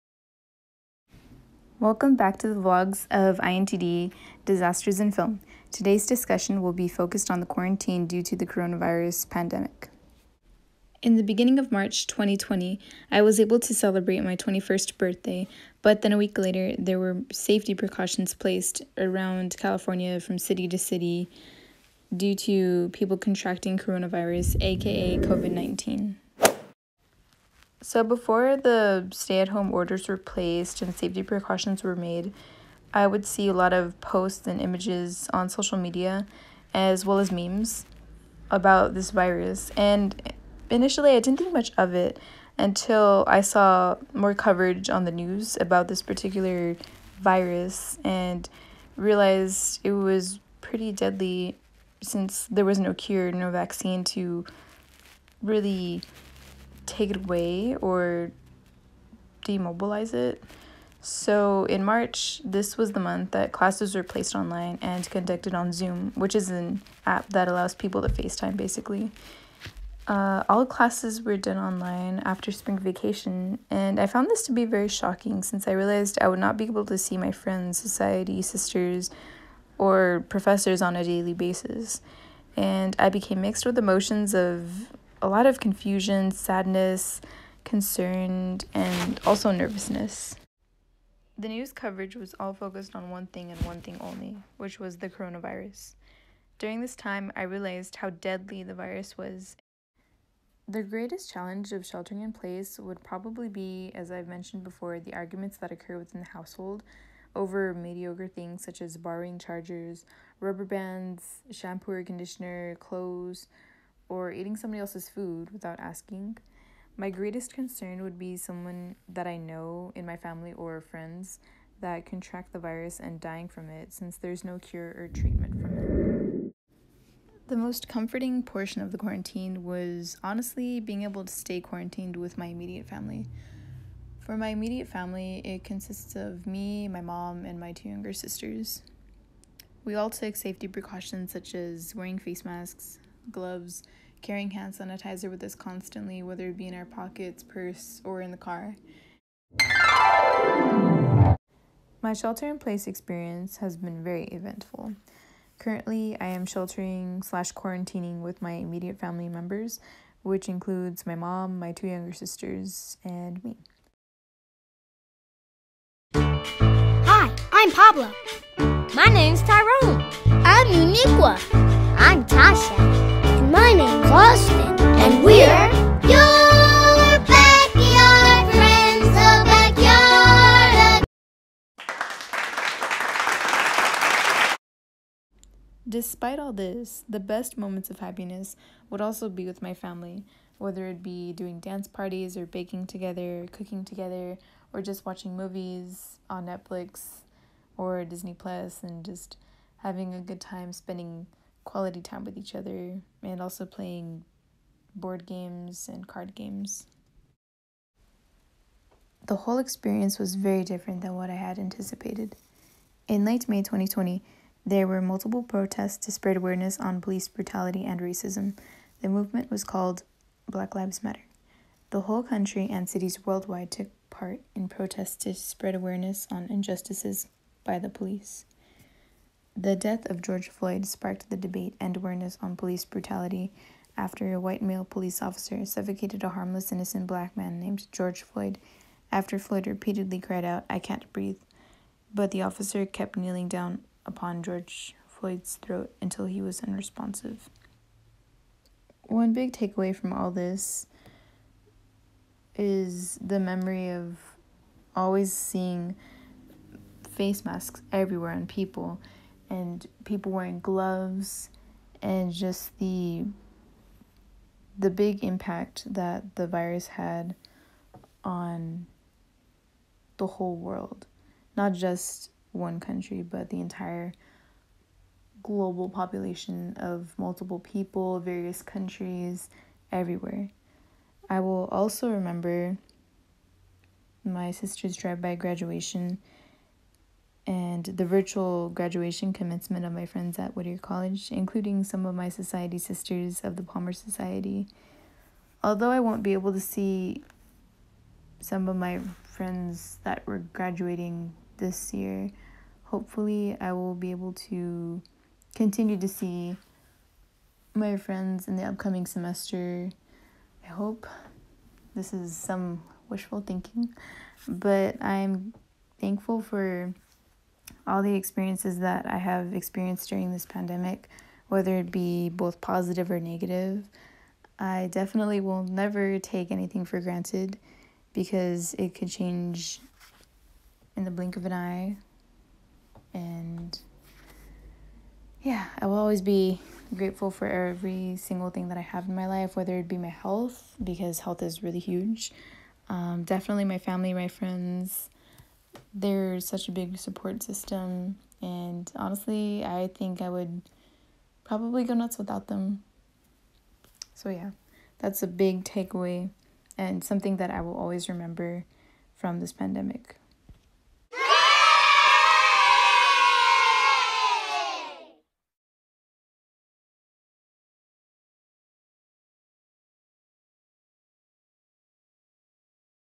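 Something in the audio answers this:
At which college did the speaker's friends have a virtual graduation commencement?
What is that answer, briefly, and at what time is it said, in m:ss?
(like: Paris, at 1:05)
Whittier College, at 4:50.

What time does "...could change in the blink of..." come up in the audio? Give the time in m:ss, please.
5:28.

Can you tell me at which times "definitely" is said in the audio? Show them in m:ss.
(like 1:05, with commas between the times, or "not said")
5:24, 5:43.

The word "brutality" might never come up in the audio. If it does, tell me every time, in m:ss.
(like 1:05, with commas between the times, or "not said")
3:37, 3:52.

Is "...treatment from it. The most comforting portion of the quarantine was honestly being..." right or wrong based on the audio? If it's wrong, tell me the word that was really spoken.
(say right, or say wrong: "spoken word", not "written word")
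right.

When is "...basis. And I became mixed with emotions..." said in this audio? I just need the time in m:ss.
1:21.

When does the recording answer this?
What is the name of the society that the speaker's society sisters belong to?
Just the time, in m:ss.
4:53.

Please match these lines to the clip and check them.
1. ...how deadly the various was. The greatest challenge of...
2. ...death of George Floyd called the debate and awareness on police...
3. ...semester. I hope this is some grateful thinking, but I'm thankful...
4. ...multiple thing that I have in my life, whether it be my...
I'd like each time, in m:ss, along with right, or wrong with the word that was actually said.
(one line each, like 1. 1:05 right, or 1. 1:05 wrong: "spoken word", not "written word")
1. 1:37 wrong: "virus", not "various"
2. 3:49 wrong: "sparked", not "called"
3. 5:09 wrong: "wishful", not "grateful"
4. 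5:38 wrong: "single", not "multiple".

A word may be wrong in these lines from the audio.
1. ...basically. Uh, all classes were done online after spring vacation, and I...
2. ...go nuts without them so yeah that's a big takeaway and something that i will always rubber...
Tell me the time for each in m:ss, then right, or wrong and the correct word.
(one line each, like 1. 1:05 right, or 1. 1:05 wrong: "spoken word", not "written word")
1. 1:08 right
2. 5:51 wrong: "remember", not "rubber".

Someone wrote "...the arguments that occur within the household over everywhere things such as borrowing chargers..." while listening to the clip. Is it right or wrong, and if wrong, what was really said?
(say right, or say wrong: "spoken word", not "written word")
wrong: "mediocre", not "everywhere".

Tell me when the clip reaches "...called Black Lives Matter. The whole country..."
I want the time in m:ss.
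3:39.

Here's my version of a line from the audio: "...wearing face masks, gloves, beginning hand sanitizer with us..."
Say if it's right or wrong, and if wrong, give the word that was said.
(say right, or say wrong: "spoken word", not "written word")
wrong: "carrying", not "beginning".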